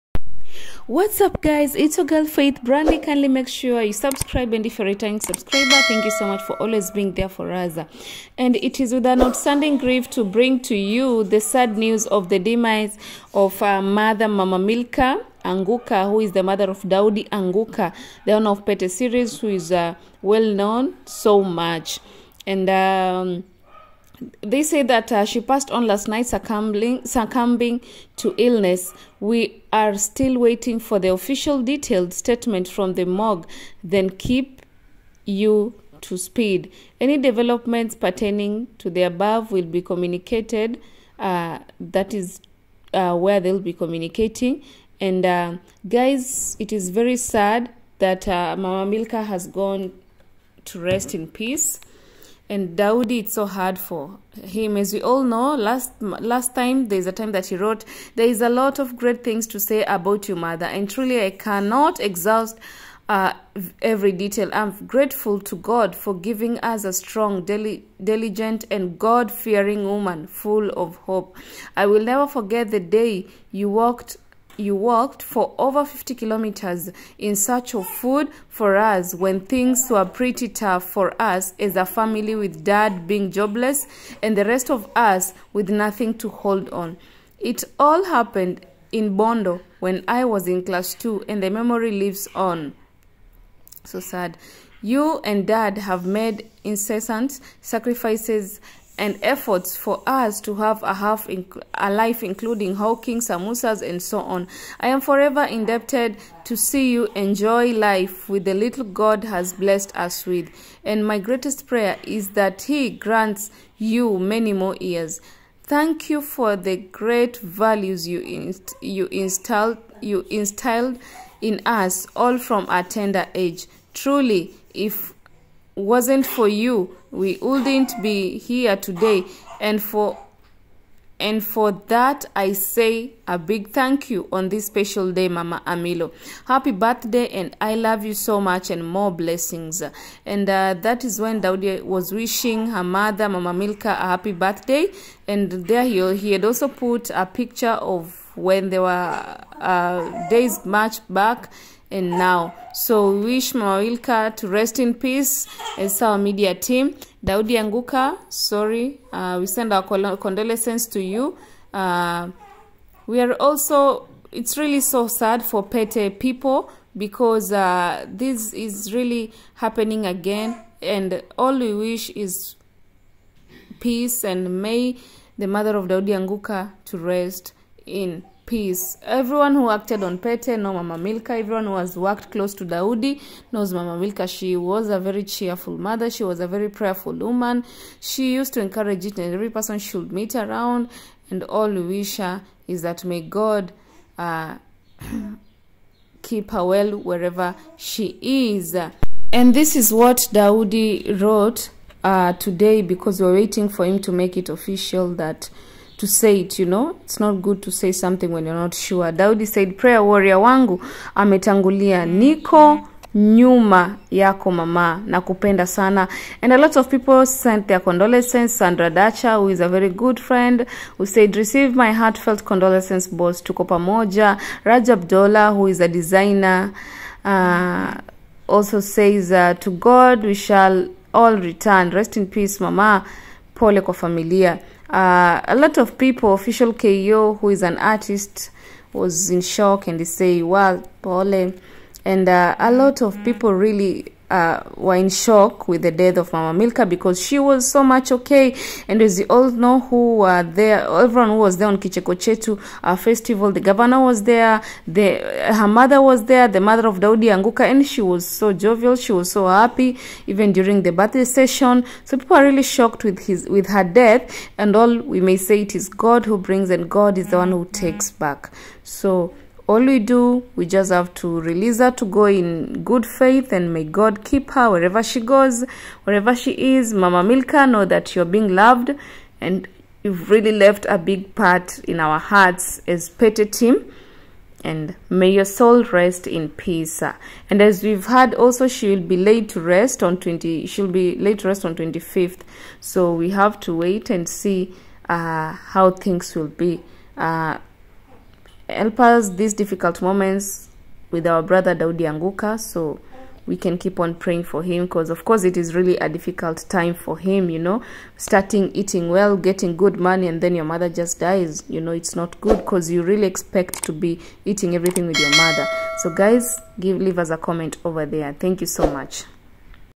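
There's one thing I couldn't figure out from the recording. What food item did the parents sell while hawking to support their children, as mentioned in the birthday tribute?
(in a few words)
Samosas.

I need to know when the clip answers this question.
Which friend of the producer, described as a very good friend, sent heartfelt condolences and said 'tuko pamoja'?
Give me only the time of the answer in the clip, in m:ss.
3:38.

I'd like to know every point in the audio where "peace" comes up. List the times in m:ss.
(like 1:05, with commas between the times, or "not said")
0:51, 2:34, 2:53, 2:58, 3:52, 4:46.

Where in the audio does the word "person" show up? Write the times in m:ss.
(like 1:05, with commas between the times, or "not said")
3:09.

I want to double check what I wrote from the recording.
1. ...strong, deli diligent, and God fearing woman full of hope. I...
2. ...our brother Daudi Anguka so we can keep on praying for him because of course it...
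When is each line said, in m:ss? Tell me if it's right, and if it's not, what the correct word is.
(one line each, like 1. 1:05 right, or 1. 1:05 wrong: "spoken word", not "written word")
1. 1:06 right
2. 5:01 right.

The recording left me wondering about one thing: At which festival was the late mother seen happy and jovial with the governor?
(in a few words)
Kichekochetu.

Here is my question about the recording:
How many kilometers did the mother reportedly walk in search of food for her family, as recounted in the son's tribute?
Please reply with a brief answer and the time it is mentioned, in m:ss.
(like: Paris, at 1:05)
Over 50, at 1:15.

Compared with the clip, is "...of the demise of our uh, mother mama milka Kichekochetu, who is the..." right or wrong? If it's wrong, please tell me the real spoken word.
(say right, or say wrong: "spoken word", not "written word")
wrong: "Anguka", not "Kichekochetu".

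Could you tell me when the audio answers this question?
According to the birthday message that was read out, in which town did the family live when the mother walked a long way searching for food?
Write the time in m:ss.
1:29.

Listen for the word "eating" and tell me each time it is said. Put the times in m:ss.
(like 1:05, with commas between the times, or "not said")
5:08, 5:14.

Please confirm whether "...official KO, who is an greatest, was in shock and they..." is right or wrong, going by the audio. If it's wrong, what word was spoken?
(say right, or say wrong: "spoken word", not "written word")
wrong: "artist", not "greatest".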